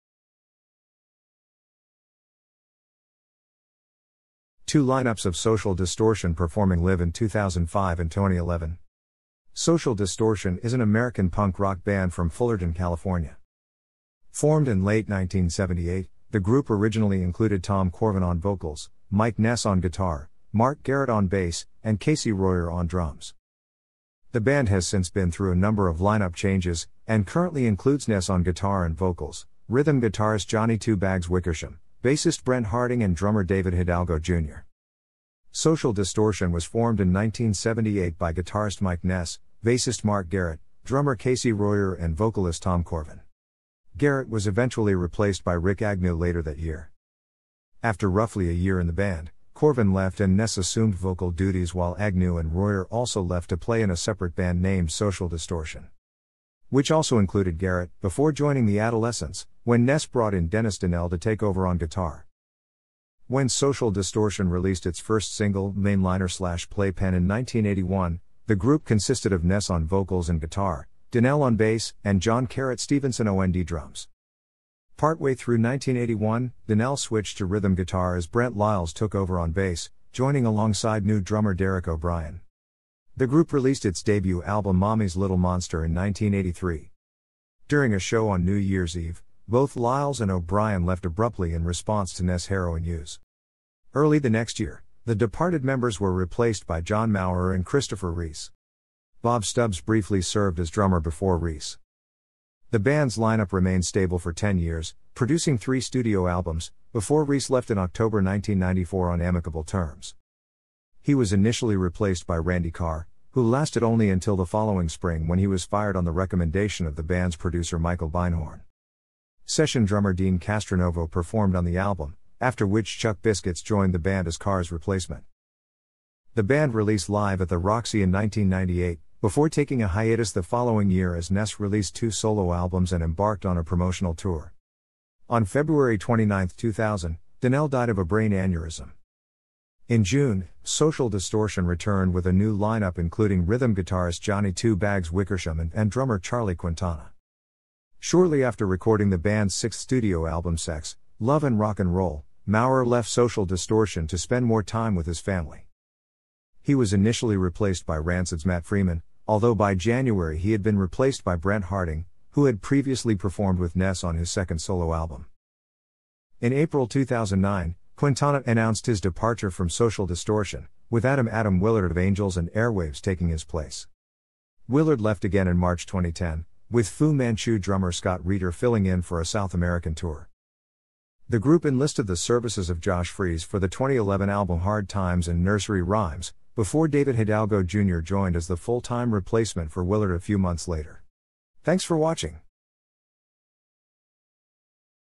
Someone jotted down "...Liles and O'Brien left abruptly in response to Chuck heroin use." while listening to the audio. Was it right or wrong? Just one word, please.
wrong.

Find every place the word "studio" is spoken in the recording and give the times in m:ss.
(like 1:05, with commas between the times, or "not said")
1:45, 2:29.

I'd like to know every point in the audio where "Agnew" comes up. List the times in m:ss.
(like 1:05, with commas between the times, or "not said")
0:45, 0:51.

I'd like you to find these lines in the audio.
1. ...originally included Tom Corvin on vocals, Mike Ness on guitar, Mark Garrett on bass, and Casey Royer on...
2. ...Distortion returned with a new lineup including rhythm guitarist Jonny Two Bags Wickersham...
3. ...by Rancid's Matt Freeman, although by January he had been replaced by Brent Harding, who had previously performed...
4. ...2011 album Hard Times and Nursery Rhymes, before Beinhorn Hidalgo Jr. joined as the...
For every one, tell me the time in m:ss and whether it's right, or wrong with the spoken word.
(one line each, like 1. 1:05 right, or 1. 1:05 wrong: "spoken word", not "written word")
1. 0:16 right
2. 2:21 right
3. 2:37 right
4. 3:03 wrong: "David", not "Beinhorn".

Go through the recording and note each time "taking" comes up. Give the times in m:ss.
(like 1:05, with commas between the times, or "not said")
2:09, 2:52.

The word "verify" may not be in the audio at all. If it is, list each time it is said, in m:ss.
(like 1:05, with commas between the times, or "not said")
not said.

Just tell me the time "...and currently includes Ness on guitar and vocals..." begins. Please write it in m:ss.
0:27.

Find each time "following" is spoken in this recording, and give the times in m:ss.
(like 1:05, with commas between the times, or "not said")
1:54, 2:10.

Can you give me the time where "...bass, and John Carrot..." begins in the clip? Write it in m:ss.
1:11.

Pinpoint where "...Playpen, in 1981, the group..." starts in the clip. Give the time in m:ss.
1:06.